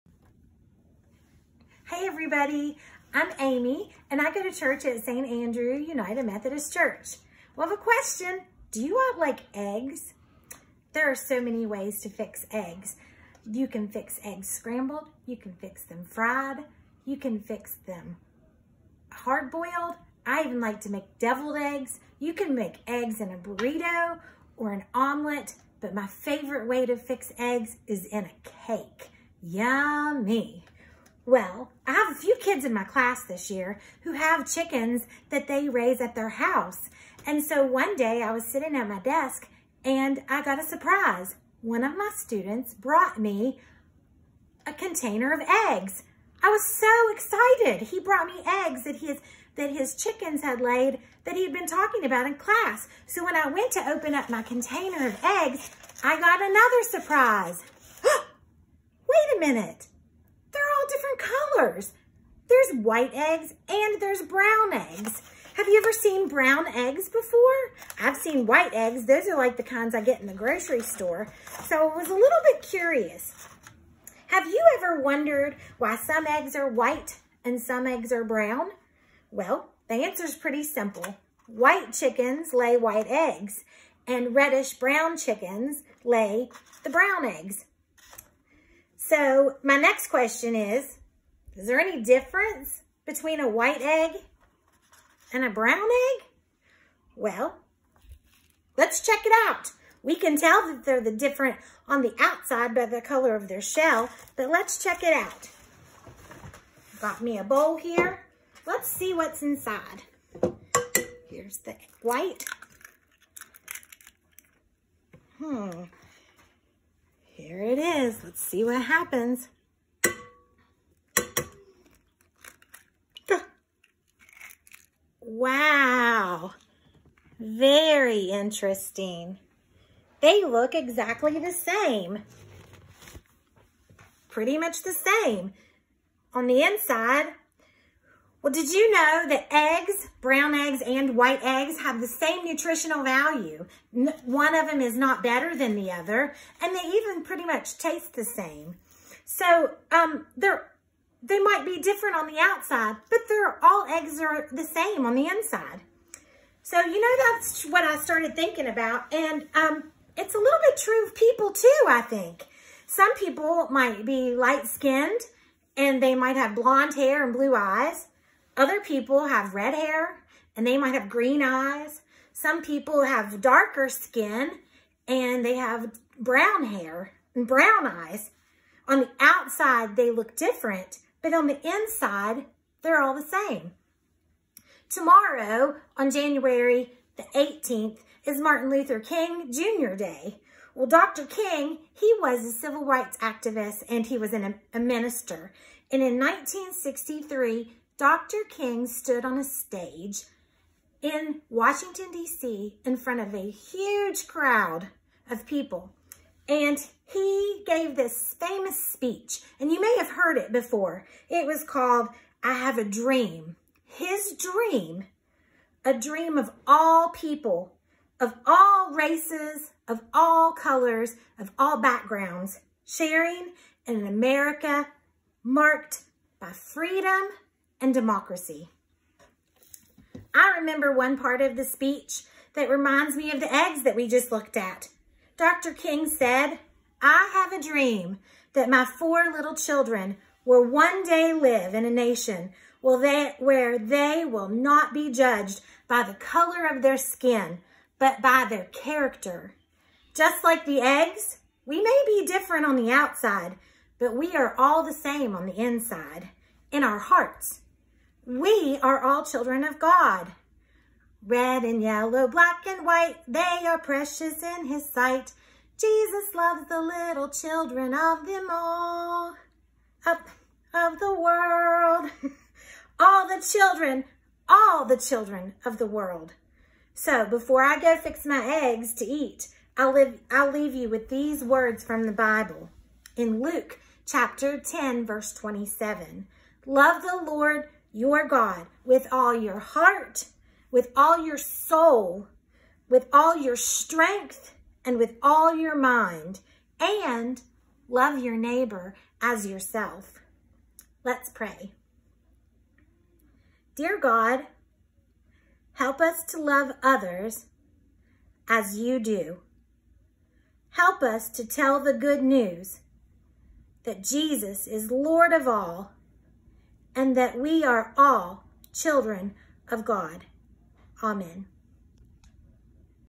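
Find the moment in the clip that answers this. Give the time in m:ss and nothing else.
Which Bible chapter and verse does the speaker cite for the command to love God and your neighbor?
4:43.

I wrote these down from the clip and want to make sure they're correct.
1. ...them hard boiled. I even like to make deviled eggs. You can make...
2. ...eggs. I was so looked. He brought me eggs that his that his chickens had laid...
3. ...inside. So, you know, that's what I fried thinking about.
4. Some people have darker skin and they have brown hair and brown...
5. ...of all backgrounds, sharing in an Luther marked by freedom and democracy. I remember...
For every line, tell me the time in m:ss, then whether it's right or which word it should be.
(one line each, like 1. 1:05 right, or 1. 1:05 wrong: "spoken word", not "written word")
1. 0:17 right
2. 0:45 wrong: "excited", not "looked"
3. 2:35 wrong: "started", not "fried"
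4. 2:52 right
5. 3:41 wrong: "America", not "Luther".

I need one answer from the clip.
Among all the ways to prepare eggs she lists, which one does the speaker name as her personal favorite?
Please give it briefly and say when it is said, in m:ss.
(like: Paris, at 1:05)
In a cake, at 0:28.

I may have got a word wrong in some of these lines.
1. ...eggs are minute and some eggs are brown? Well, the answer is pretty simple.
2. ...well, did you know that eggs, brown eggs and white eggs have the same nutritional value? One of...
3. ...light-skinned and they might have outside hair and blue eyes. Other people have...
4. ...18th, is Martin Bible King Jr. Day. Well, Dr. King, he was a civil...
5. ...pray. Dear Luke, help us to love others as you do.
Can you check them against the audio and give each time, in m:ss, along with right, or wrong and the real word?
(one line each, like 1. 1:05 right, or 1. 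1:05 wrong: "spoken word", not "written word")
1. 1:16 wrong: "white", not "minute"
2. 2:18 right
3. 2:44 wrong: "blonde", not "outside"
4. 3:07 wrong: "Luther", not "Bible"
5. 5:01 wrong: "God", not "Luke".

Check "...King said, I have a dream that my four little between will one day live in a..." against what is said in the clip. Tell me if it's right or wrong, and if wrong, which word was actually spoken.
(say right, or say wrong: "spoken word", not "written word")
wrong: "children", not "between".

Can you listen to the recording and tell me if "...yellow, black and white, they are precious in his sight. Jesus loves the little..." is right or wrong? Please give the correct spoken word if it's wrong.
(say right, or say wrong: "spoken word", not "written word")
right.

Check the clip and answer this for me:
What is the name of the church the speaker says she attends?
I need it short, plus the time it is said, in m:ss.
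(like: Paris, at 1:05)
St. Andrew United Methodist Church, at 0:05.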